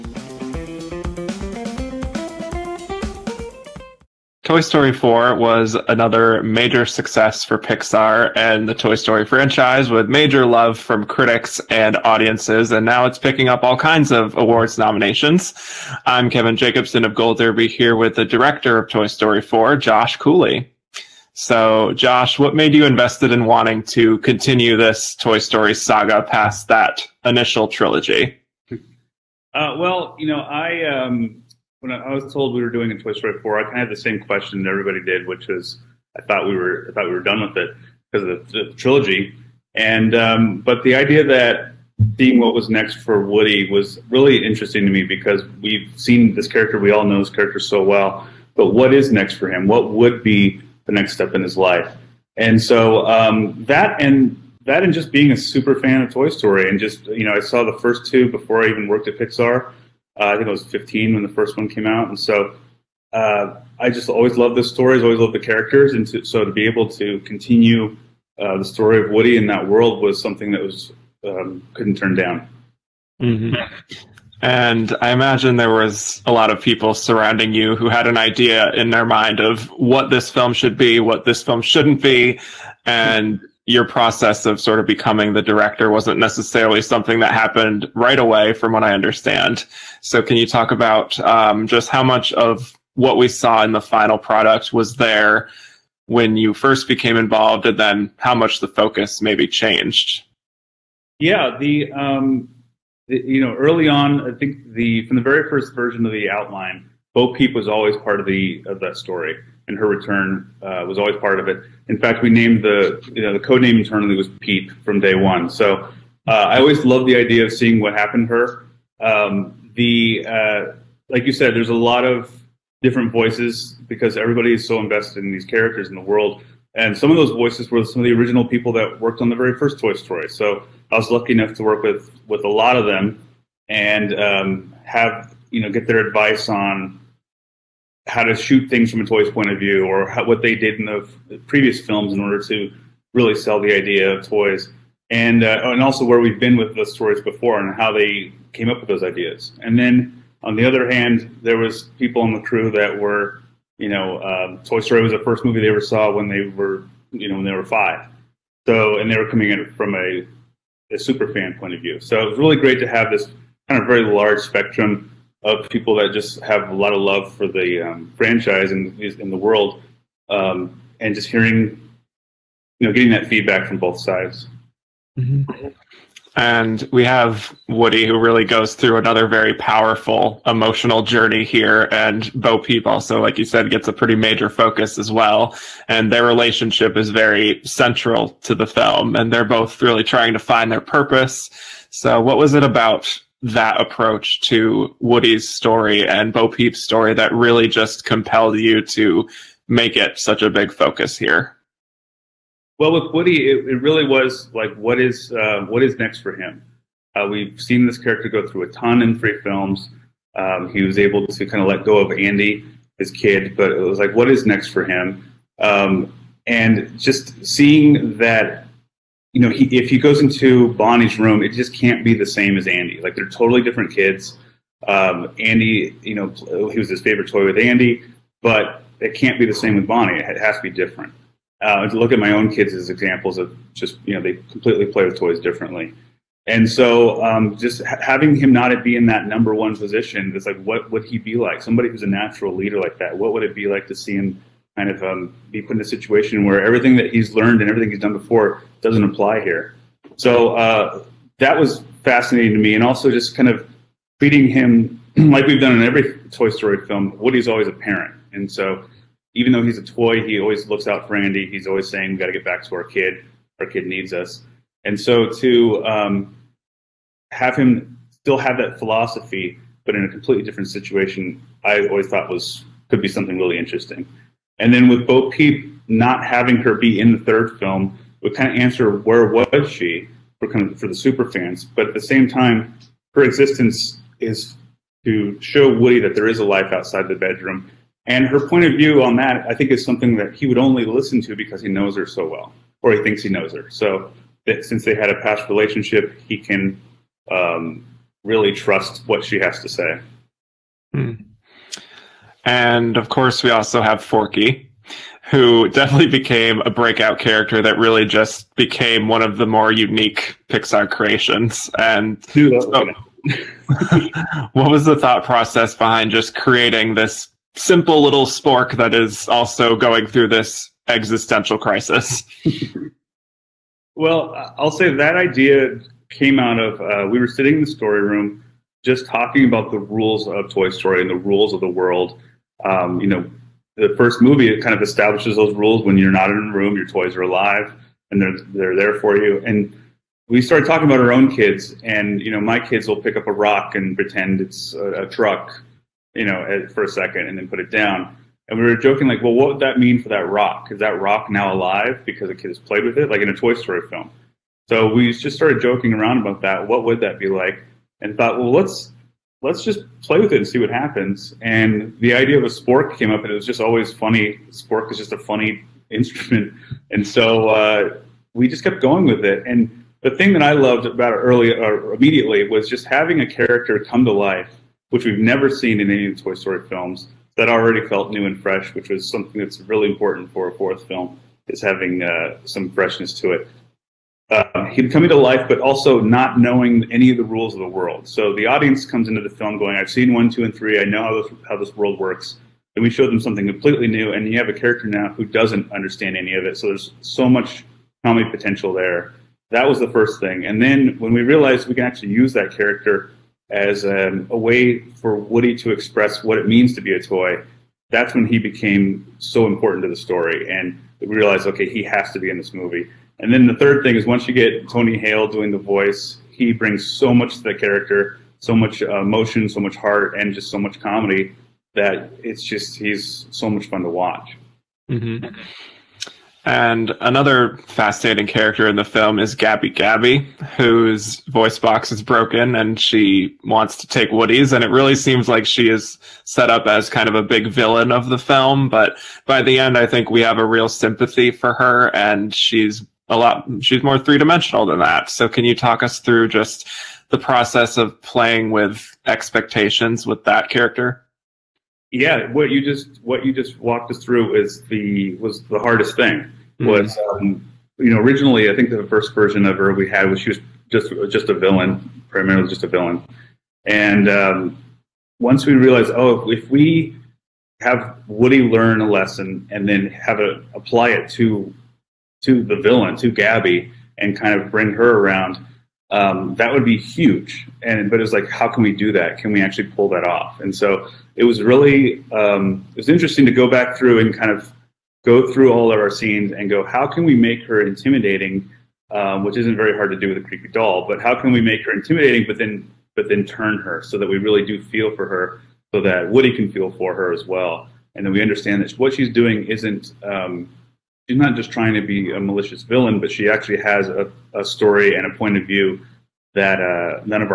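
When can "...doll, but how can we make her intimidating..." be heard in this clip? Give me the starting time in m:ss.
8:10.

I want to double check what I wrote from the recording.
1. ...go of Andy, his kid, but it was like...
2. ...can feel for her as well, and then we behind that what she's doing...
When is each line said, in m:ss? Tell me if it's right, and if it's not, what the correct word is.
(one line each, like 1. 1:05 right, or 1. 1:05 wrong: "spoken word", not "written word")
1. 3:31 right
2. 8:16 wrong: "understand", not "behind".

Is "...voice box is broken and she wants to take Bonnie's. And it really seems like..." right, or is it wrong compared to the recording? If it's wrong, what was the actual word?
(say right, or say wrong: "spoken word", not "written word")
wrong: "Woody", not "Bonnie".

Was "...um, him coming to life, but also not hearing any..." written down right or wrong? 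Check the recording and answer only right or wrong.
wrong.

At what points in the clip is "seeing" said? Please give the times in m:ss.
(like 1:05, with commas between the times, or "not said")
0:42, 1:57, 3:37.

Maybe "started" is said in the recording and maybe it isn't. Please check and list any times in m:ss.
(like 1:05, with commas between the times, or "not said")
5:40, 5:55.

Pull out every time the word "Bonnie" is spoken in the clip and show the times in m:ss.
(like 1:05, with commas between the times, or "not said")
3:40, 3:49.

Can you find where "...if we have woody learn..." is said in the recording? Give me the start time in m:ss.
7:46.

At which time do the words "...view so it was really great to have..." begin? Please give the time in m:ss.
2:41.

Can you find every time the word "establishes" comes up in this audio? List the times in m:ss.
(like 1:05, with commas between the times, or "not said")
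5:34.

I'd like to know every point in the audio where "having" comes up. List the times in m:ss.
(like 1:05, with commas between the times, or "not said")
3:58, 4:36, 6:12, 6:21.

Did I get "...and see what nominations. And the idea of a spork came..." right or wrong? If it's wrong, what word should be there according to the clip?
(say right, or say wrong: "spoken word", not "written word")
wrong: "happens", not "nominations".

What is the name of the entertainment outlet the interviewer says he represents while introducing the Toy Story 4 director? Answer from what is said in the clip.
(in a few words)
Gold Derby.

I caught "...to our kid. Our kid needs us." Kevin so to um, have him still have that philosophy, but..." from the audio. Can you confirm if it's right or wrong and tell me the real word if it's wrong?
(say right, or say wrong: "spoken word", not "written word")
wrong: "And", not "Kevin".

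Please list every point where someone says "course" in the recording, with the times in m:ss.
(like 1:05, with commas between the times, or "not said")
5:03.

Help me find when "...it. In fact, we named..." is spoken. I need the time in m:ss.
1:51.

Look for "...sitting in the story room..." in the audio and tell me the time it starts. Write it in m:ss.
5:27.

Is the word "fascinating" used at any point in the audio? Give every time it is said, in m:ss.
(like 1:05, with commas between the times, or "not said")
4:12, 7:07.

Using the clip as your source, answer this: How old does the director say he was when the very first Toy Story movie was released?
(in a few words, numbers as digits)
15.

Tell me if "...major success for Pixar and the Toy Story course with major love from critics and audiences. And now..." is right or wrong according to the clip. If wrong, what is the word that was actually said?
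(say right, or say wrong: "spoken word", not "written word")
wrong: "franchise", not "course".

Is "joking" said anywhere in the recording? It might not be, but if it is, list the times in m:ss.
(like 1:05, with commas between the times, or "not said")
5:48, 5:55.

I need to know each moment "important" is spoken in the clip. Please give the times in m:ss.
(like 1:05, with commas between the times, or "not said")
6:19, 6:49.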